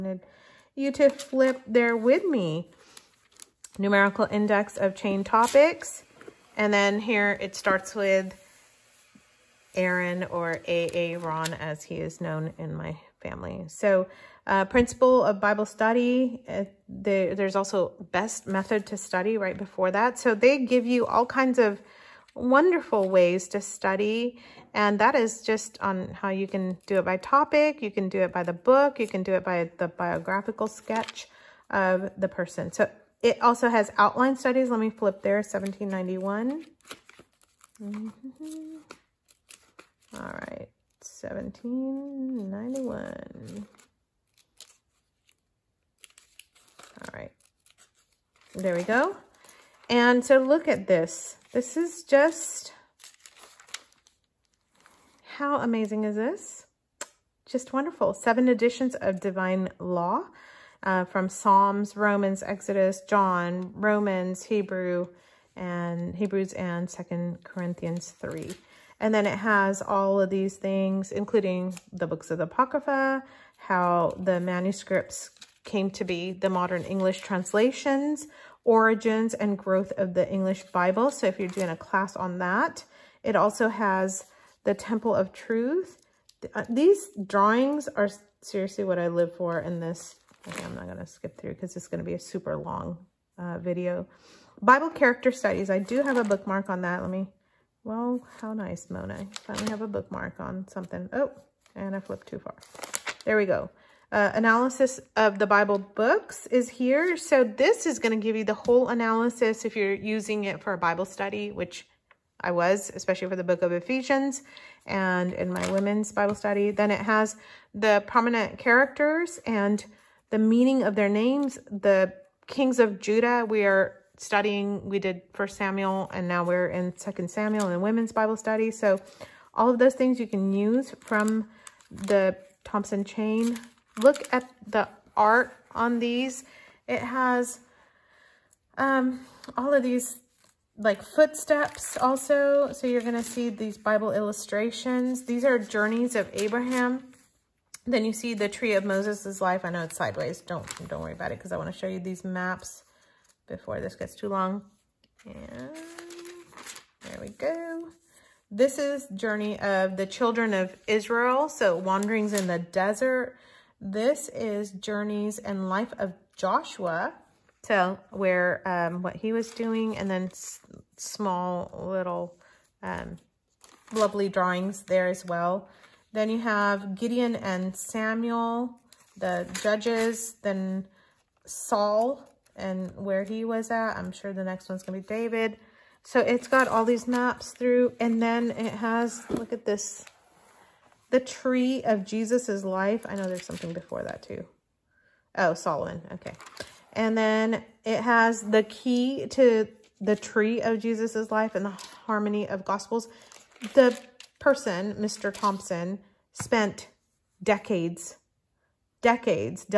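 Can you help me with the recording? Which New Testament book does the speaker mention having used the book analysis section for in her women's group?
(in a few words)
Ephesians.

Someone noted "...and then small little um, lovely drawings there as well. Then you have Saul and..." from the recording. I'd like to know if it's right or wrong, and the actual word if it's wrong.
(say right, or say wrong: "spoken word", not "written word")
wrong: "Gideon", not "Saul".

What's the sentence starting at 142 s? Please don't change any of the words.
So you're going to see these Bible illustrations.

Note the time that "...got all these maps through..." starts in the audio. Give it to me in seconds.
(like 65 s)
186 s.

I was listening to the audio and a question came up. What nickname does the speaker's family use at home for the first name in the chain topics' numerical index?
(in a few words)
A.A. 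Ron.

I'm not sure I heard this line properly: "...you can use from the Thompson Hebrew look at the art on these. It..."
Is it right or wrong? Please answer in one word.
wrong.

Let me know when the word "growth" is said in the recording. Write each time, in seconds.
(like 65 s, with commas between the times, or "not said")
79 s.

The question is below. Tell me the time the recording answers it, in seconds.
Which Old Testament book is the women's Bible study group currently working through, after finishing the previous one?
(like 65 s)
126 s.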